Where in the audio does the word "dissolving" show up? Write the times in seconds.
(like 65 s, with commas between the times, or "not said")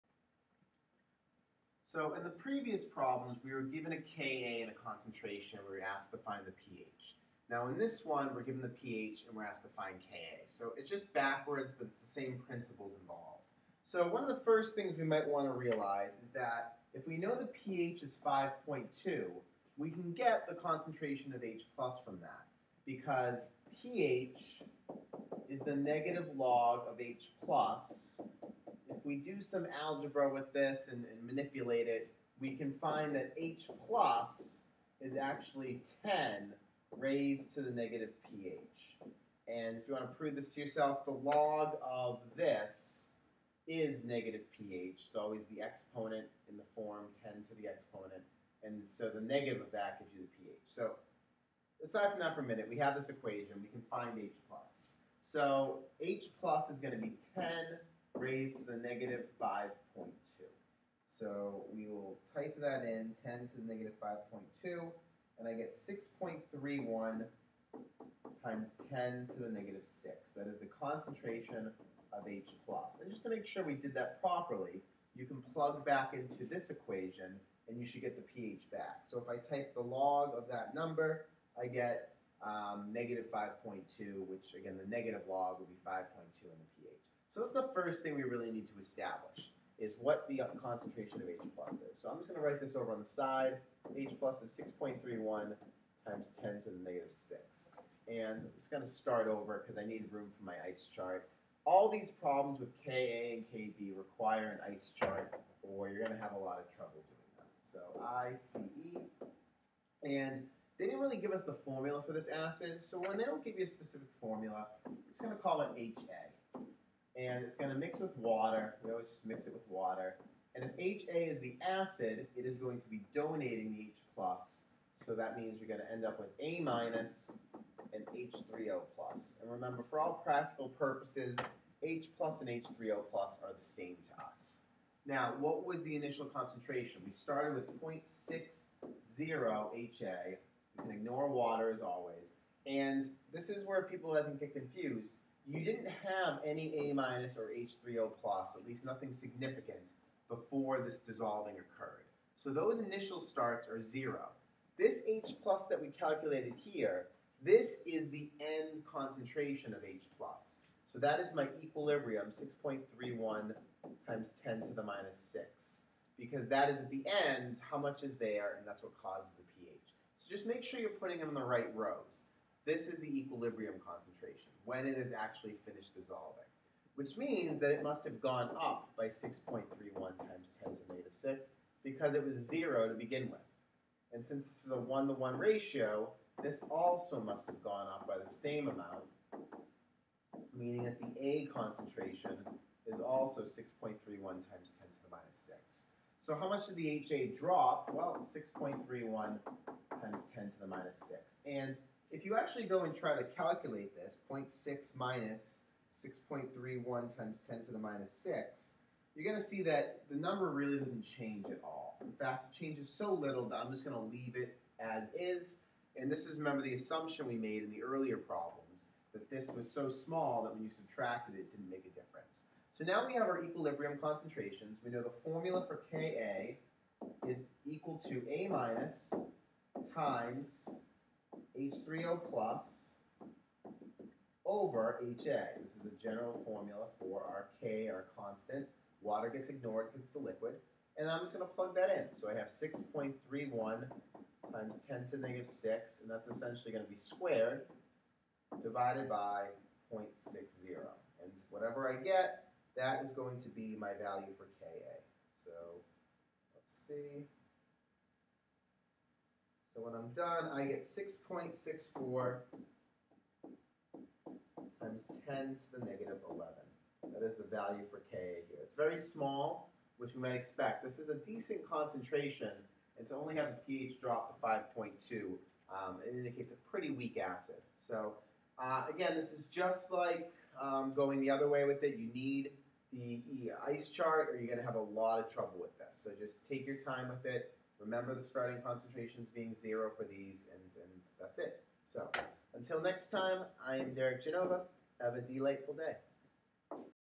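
150 s, 175 s.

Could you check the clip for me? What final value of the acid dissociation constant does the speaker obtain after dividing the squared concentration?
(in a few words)
6.64 × 10^-11.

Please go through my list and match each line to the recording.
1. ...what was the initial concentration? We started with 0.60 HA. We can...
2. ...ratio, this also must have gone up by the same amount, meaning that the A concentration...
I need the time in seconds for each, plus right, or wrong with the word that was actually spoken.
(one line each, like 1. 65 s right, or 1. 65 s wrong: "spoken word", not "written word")
1. 135 s right
2. 185 s right.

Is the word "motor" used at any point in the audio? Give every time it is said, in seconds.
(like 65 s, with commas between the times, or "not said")
not said.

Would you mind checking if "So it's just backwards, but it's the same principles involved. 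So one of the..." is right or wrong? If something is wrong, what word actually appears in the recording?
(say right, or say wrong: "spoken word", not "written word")
right.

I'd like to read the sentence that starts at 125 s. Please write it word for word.
so that means you're going to end up with A- minus and H3O+.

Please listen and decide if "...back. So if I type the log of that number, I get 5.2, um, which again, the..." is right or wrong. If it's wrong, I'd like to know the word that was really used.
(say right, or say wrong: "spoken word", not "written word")
right.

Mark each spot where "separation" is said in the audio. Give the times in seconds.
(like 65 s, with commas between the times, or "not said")
not said.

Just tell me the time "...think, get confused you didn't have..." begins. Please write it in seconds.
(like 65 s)
144 s.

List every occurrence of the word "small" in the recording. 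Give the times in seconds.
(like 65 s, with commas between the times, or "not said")
219 s, 268 s.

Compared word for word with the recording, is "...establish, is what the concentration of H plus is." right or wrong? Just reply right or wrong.
right.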